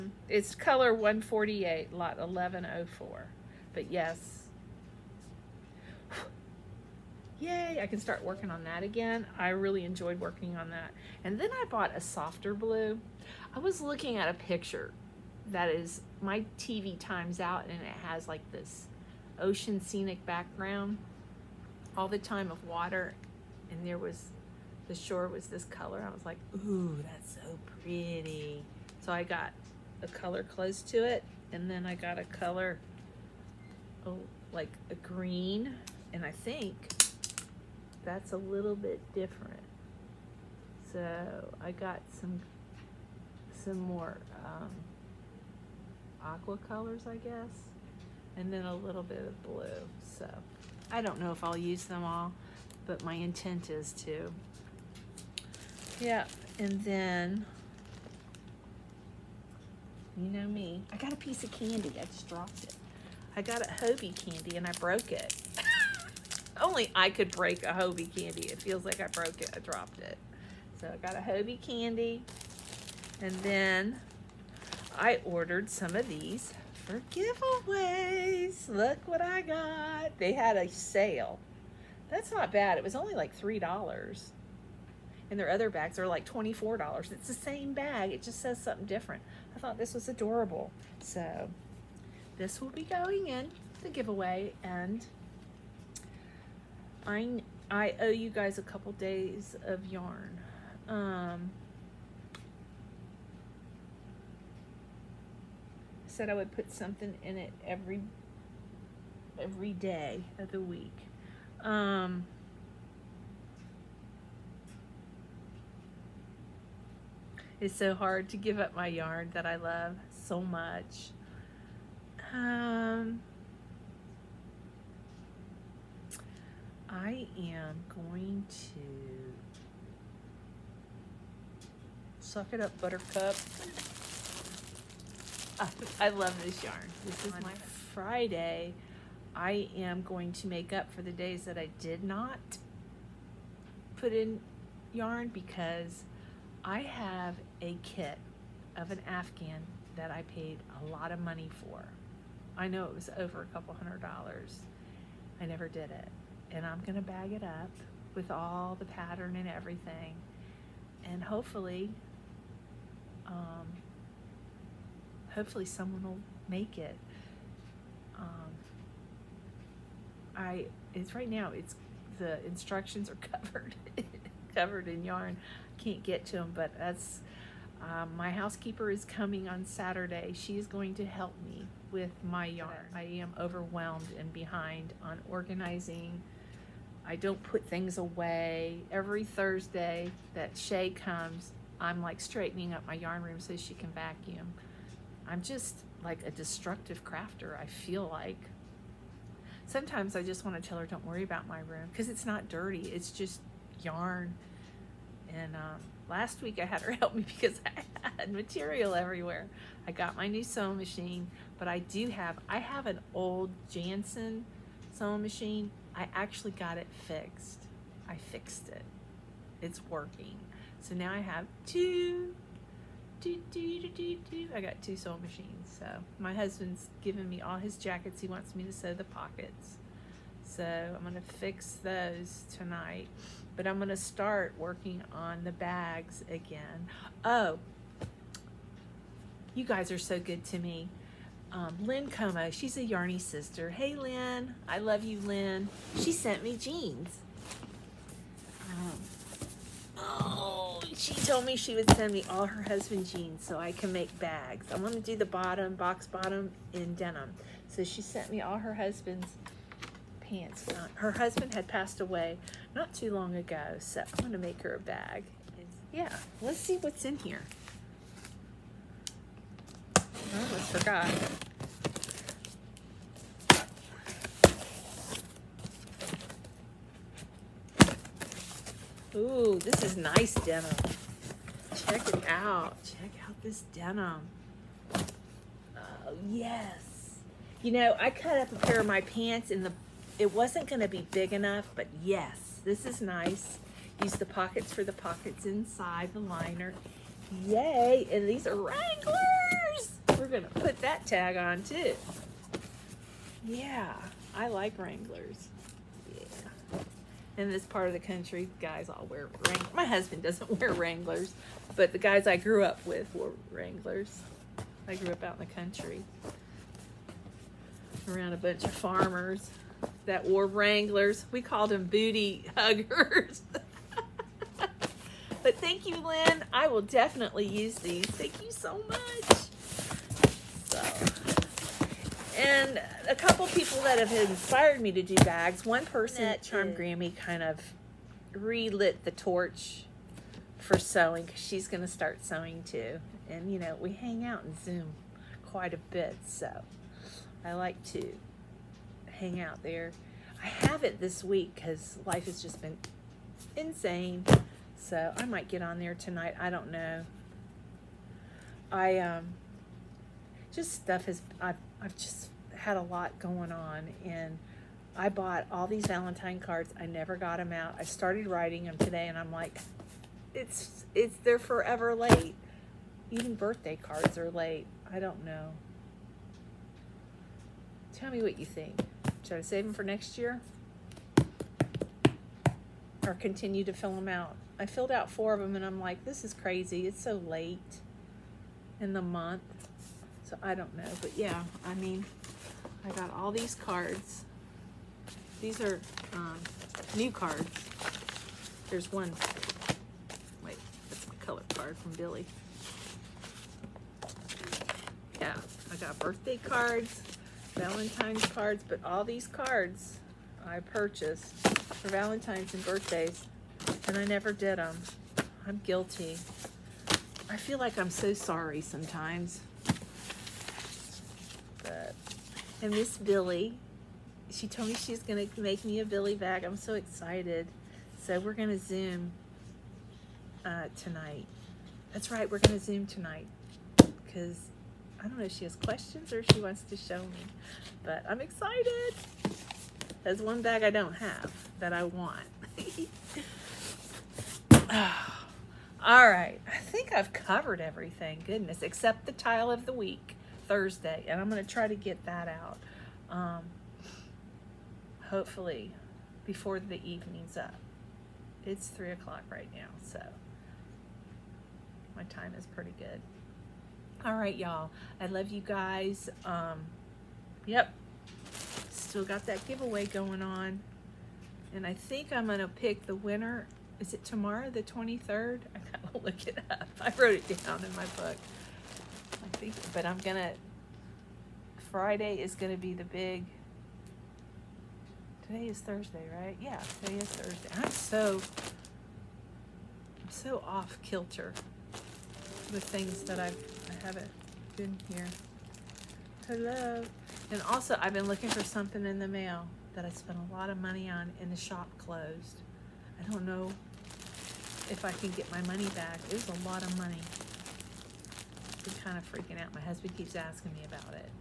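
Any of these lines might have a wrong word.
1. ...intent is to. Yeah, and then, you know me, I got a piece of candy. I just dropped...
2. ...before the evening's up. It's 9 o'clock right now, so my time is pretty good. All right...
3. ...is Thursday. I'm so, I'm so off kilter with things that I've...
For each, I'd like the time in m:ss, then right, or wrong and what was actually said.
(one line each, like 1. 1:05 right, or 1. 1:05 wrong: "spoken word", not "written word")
1. 0:53 right
2. 7:36 wrong: "3", not "9"
3. 8:06 right.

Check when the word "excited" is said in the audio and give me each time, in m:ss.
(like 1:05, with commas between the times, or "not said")
7:06, 7:18.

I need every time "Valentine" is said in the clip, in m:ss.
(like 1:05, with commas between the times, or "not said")
6:05, 6:47, 6:51.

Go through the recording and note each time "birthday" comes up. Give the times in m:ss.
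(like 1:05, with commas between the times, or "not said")
6:13, 6:45, 6:52.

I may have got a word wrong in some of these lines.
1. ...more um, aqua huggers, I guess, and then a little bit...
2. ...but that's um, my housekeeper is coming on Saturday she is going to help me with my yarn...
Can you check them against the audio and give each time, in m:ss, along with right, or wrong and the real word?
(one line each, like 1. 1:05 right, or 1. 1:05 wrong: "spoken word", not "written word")
1. 0:43 wrong: "colors", not "huggers"
2. 2:56 right.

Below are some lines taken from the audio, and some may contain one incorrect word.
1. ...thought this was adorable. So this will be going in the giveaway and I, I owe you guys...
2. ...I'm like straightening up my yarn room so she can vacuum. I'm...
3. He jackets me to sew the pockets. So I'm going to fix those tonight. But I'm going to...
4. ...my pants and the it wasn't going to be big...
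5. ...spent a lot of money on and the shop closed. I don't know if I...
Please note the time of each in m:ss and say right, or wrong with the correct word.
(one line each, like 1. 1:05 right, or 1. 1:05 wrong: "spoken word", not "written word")
1. 1:29 right
2. 3:11 right
3. 3:48 wrong: "wants", not "jackets"
4. 4:48 right
5. 8:19 right.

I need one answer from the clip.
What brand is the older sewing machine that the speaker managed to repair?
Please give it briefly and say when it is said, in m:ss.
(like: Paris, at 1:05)
Janssen, at 3:33.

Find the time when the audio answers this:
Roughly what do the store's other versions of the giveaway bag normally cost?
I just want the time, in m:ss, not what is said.
1:26.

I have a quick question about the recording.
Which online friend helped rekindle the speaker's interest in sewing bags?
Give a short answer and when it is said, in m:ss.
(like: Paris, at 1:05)
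Charmed Grammy, at 5:36.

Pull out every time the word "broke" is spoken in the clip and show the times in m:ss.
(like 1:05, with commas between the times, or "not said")
1:04, 1:09.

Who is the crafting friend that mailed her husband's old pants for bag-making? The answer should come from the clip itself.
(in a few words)
Lynn Como.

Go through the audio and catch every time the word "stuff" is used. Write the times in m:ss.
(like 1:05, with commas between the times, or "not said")
6:00.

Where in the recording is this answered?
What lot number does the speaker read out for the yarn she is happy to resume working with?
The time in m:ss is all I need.
0:01.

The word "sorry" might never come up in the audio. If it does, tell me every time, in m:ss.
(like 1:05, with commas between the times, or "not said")
6:58.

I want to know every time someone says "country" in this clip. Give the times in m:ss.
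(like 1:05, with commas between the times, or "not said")
5:07, 5:15.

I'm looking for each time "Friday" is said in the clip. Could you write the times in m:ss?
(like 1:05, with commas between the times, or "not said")
2:17, 8:01.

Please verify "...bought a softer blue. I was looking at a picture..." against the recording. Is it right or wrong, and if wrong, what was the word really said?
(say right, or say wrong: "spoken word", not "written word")
right.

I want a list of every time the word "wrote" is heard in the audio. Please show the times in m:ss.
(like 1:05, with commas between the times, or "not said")
7:56.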